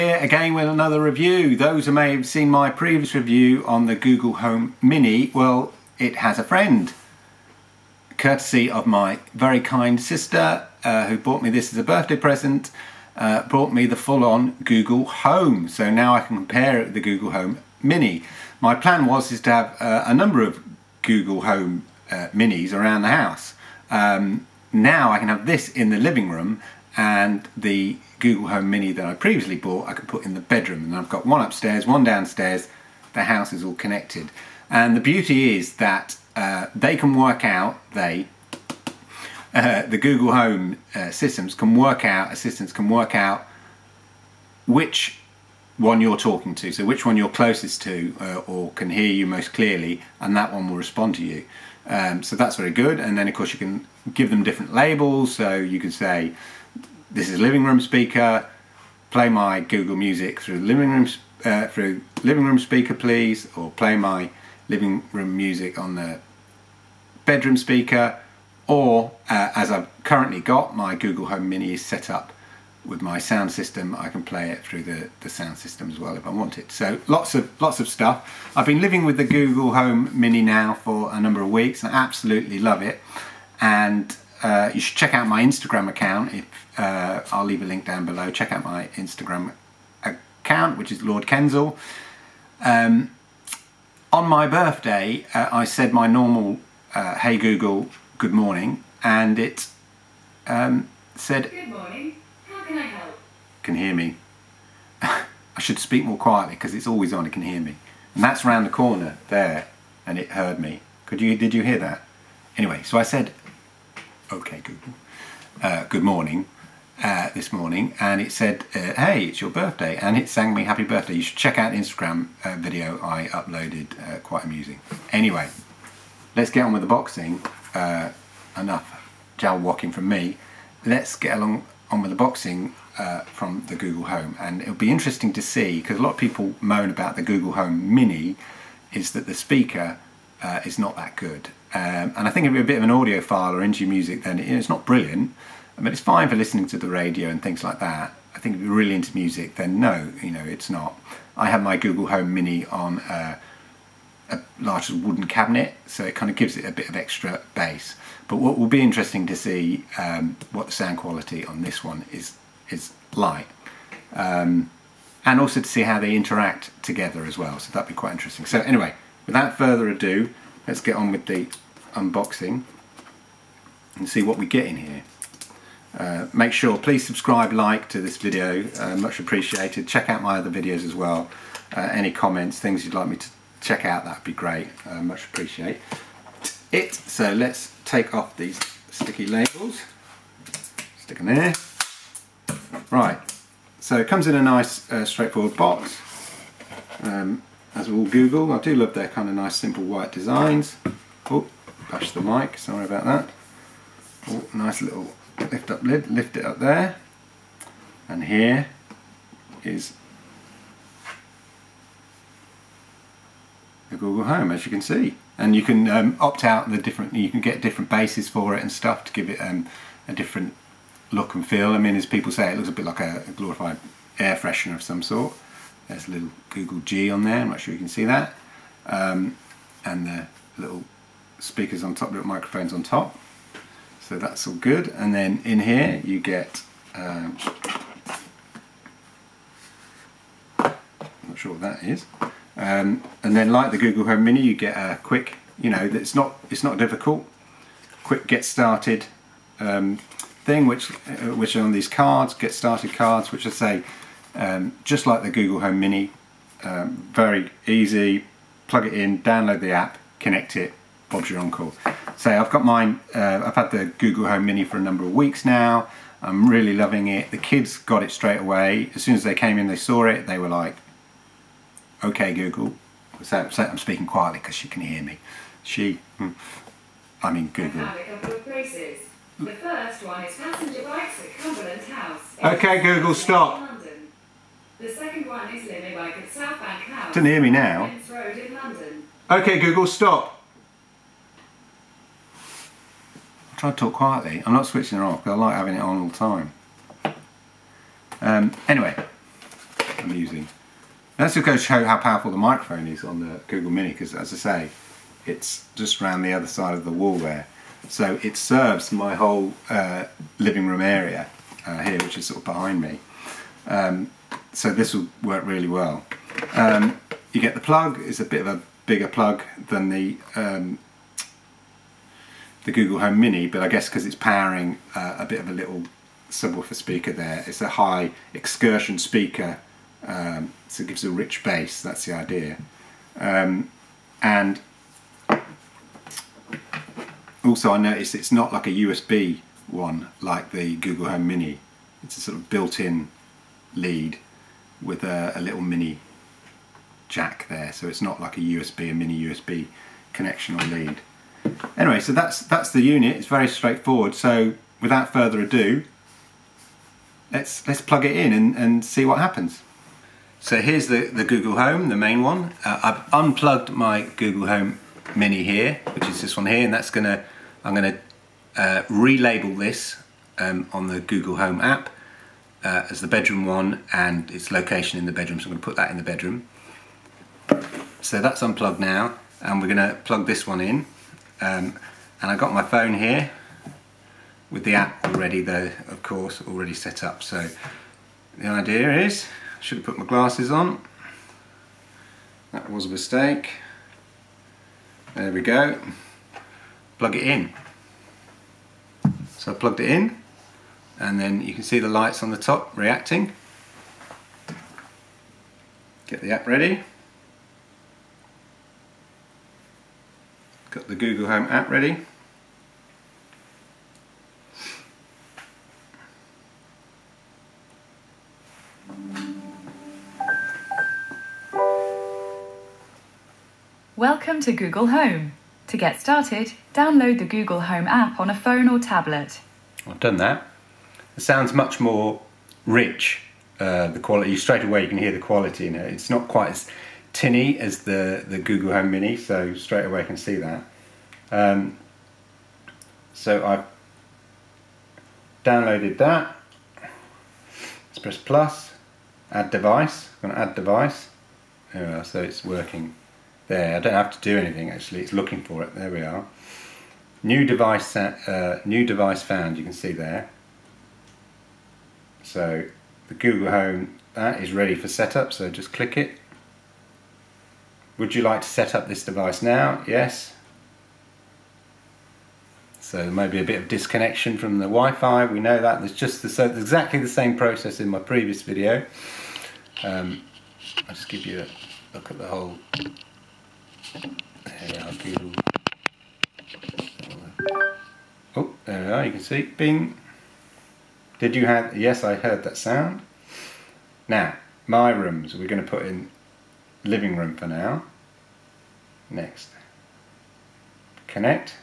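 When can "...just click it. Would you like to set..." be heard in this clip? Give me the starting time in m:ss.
7:45.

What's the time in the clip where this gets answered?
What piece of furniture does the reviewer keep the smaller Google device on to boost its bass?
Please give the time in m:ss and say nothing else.
2:34.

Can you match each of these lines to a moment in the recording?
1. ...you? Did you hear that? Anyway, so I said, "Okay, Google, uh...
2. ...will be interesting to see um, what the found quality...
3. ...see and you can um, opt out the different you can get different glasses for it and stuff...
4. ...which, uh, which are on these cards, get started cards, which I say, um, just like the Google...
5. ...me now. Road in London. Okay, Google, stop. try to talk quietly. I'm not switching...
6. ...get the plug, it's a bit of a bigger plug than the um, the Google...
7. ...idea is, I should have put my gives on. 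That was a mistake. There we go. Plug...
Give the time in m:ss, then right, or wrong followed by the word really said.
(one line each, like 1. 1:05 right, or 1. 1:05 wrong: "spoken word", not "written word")
1. 1:51 right
2. 2:38 wrong: "sound", not "found"
3. 3:34 wrong: "bases", not "glasses"
4. 4:10 right
5. 4:47 right
6. 5:17 right
7. 6:28 wrong: "glasses", not "gives".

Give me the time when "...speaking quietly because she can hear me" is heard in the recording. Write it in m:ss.
4:33.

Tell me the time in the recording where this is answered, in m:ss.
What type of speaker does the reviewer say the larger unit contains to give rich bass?
5:27.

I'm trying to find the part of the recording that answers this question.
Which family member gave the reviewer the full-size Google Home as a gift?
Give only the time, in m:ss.
0:09.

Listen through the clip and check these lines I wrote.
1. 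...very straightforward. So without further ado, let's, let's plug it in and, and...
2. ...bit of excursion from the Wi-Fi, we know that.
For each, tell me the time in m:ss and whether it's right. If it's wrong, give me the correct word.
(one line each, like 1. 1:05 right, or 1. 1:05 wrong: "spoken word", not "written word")
1. 5:53 right
2. 7:53 wrong: "disconnection", not "excursion".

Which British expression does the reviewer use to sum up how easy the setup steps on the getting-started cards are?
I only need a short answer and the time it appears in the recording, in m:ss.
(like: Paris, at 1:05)
Bob's your uncle, at 4:21.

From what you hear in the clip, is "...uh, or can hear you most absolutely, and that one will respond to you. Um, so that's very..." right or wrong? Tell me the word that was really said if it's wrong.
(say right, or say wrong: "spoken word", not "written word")
wrong: "clearly", not "absolutely".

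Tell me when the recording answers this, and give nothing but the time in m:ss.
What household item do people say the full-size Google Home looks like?
3:43.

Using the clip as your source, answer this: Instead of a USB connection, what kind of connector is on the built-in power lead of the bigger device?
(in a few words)
Mini jack.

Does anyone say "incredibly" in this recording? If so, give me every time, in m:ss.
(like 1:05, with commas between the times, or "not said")
not said.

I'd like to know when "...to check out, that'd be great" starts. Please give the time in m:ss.
3:03.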